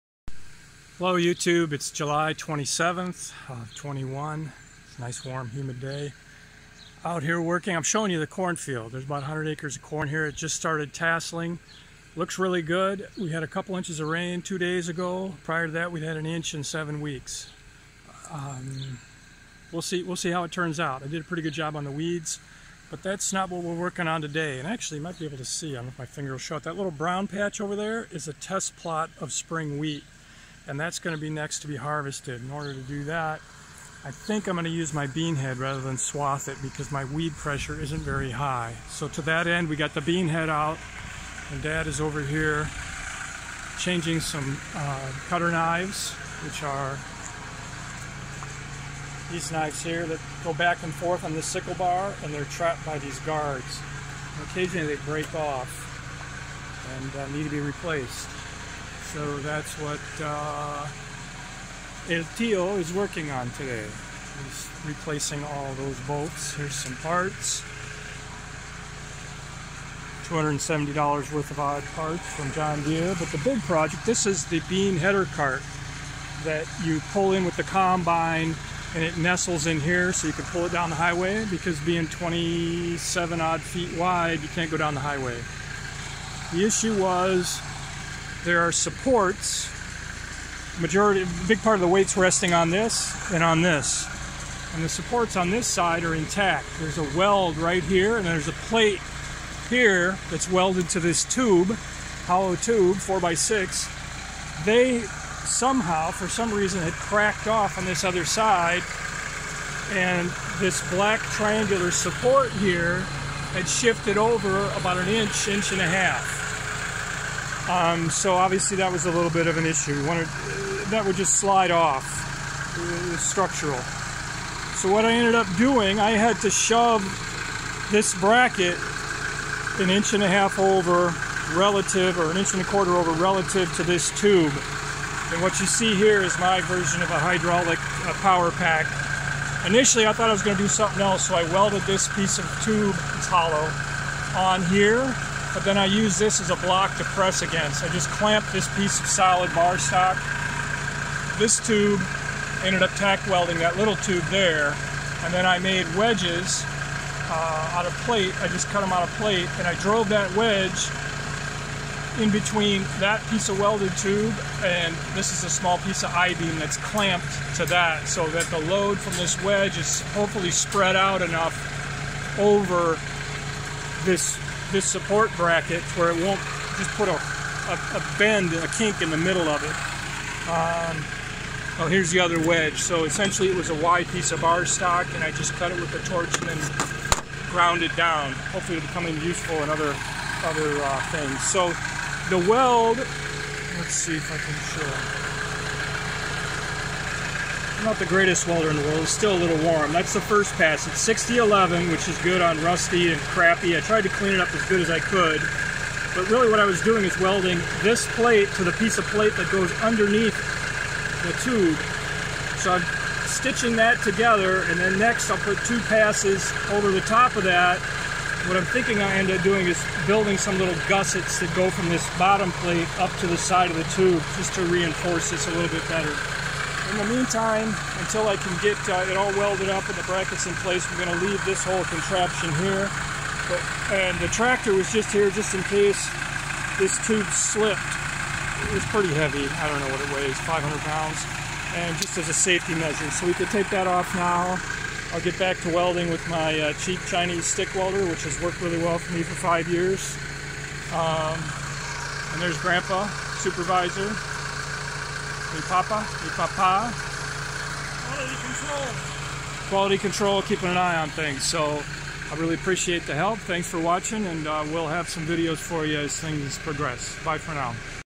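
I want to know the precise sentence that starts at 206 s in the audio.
But really what I was doing is welding this plate to the piece of plate that goes underneath the tube.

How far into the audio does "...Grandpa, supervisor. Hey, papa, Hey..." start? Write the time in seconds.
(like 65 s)
252 s.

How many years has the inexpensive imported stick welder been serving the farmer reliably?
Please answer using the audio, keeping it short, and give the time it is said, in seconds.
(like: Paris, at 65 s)
5 years, at 249 s.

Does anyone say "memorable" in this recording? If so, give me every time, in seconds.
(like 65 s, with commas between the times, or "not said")
not said.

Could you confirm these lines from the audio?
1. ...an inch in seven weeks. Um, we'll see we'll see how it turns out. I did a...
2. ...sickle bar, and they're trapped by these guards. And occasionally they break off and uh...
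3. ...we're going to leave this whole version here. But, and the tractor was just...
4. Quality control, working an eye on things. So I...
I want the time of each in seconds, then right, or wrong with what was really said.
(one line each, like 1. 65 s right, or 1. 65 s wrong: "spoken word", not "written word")
1. 16 s right
2. 51 s right
3. 230 s wrong: "contraption", not "version"
4. 259 s wrong: "keeping", not "working".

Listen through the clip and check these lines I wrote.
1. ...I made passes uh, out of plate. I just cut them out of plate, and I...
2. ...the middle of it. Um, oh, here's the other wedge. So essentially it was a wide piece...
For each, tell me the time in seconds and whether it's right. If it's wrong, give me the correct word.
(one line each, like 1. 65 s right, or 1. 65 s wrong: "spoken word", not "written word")
1. 155 s wrong: "wedges", not "passes"
2. 179 s right.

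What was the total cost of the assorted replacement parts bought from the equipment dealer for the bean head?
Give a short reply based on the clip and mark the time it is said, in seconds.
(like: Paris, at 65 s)
$270, at 70 s.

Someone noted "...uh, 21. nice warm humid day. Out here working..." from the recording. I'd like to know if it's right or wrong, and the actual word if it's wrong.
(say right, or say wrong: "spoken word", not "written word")
right.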